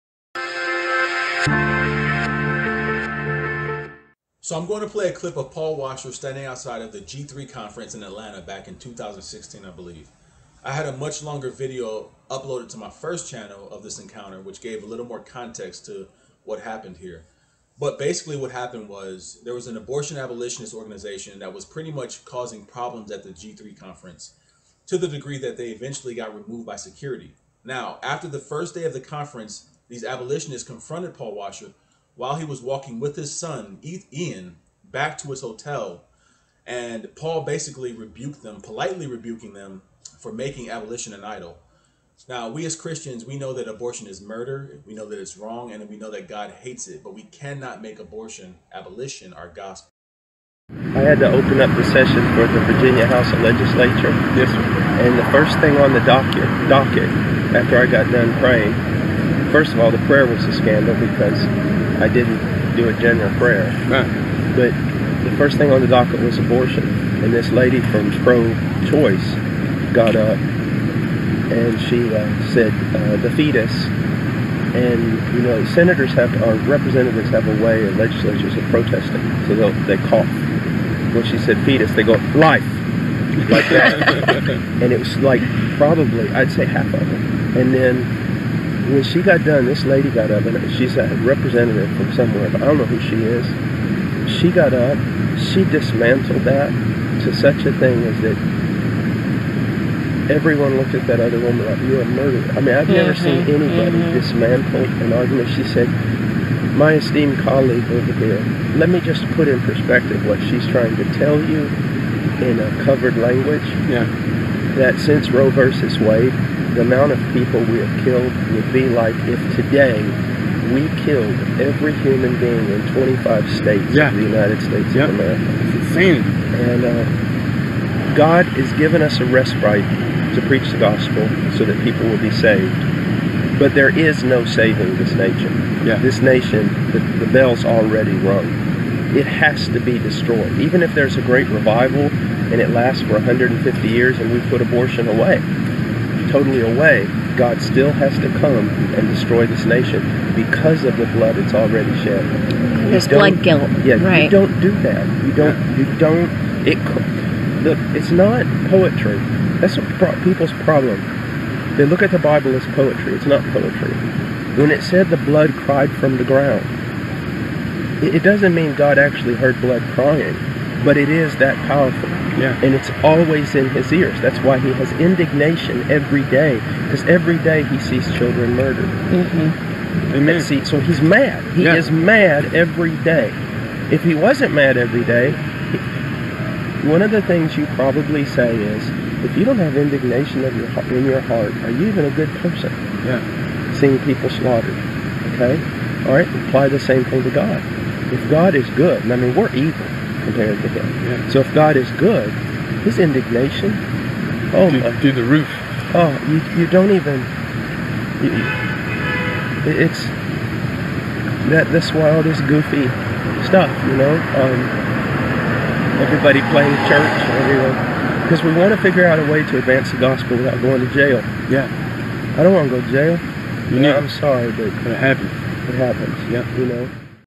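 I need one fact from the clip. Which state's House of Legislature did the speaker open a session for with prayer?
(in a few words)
Virginia.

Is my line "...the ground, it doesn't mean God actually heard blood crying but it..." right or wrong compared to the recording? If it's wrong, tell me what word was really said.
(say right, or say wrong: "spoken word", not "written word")
right.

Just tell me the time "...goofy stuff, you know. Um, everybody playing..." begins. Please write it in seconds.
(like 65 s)
212 s.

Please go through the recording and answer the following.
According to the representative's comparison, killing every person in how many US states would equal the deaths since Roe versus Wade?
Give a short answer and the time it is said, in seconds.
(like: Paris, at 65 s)
25, at 122 s.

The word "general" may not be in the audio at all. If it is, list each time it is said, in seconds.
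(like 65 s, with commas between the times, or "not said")
62 s.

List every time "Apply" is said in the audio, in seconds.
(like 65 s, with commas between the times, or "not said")
196 s.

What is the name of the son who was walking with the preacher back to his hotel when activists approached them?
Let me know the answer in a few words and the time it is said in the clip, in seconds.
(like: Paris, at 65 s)
Ian, at 33 s.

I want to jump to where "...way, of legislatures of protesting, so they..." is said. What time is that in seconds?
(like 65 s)
77 s.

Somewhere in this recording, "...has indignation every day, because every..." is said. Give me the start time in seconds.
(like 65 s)
174 s.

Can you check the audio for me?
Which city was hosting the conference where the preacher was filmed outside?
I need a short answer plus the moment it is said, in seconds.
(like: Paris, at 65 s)
Atlanta, at 8 s.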